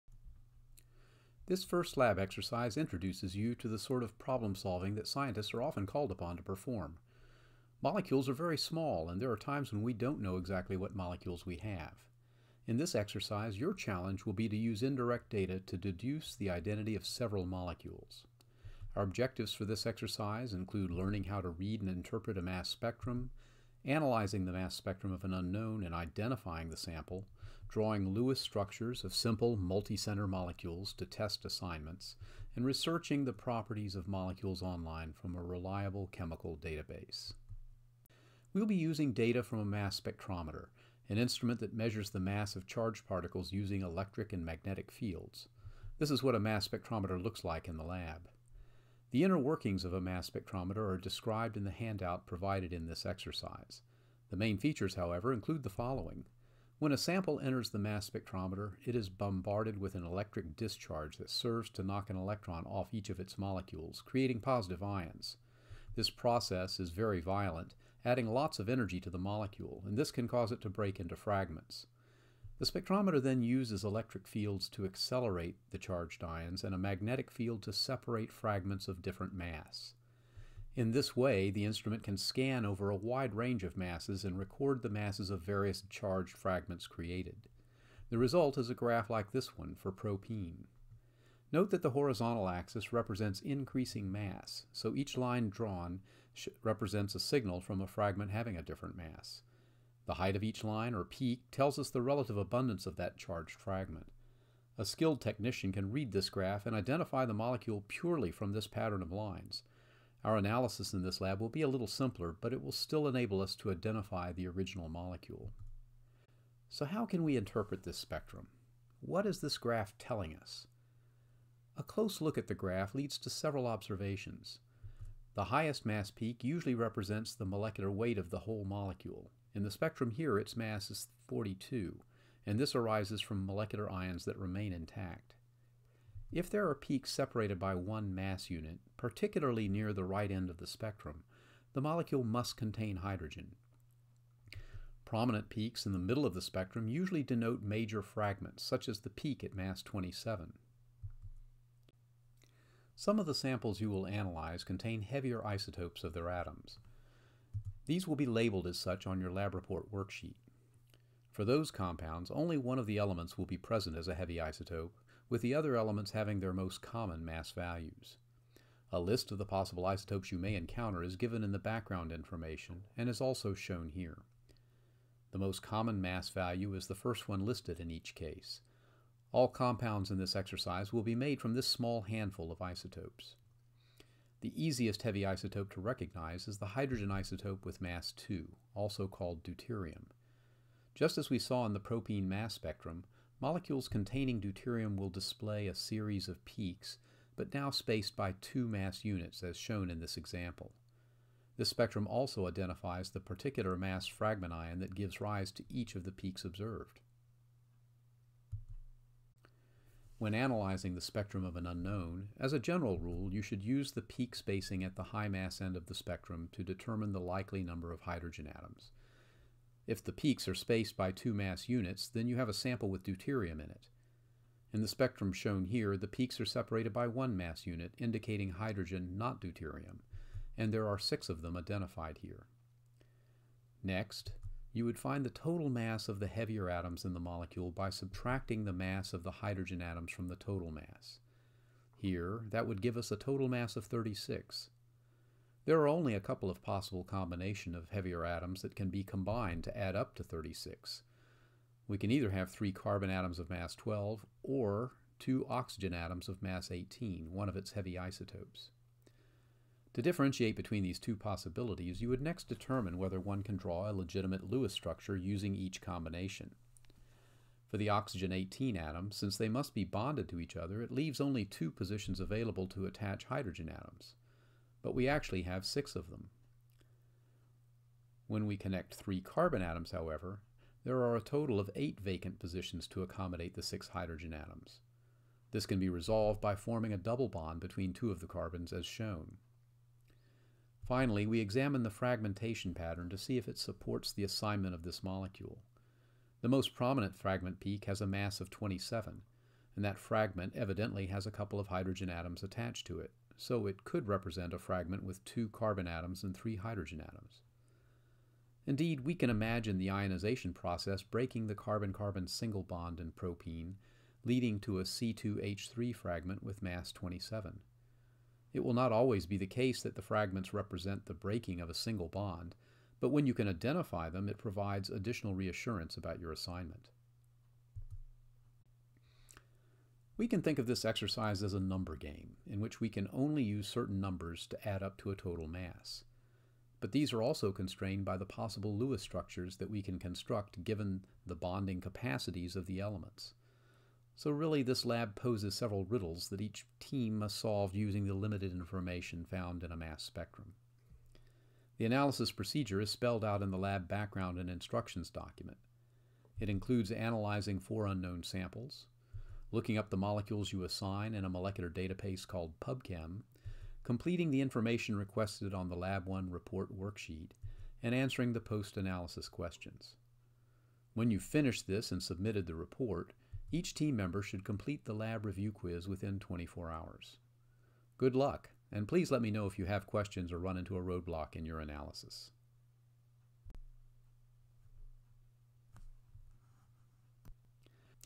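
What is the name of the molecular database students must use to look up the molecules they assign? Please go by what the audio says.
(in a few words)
PubChem.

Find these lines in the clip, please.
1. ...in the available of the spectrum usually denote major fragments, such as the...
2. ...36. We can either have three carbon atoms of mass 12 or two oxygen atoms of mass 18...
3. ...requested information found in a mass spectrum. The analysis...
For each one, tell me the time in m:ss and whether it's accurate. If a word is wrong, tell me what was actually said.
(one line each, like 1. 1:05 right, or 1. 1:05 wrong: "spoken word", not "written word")
1. 2:25 wrong: "middle", not "available"
2. 4:10 right
3. 5:48 wrong: "limited", not "requested".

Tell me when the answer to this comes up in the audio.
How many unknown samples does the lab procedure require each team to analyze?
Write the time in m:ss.
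5:57.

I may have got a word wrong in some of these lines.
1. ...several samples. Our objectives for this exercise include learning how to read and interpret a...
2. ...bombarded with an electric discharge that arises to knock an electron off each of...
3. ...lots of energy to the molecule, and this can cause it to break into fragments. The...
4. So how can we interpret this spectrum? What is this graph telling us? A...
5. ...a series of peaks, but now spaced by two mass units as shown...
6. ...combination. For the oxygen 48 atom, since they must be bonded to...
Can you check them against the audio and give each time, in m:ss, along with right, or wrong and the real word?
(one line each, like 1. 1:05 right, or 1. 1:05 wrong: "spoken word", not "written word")
1. 0:17 wrong: "molecules", not "samples"
2. 0:59 wrong: "serves", not "arises"
3. 1:08 right
4. 1:56 right
5. 3:15 right
6. 4:25 wrong: "18", not "48".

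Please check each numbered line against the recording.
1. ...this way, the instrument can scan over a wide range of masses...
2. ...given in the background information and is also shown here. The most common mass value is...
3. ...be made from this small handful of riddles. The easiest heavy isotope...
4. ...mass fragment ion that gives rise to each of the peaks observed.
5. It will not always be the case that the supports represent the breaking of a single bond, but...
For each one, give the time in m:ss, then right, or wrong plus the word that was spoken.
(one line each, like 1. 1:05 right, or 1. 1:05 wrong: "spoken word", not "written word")
1. 1:20 right
2. 2:51 right
3. 3:01 wrong: "isotopes", not "riddles"
4. 3:23 right
5. 5:18 wrong: "fragments", not "supports".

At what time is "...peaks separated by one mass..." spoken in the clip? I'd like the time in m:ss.
2:16.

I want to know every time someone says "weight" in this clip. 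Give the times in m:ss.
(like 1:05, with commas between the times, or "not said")
2:07.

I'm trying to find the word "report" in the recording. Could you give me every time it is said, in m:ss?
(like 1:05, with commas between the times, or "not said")
2:39, 6:06, 6:12.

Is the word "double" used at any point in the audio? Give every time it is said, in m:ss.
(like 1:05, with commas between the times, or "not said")
4:46.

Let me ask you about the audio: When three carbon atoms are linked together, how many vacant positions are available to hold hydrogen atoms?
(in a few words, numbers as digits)
eight.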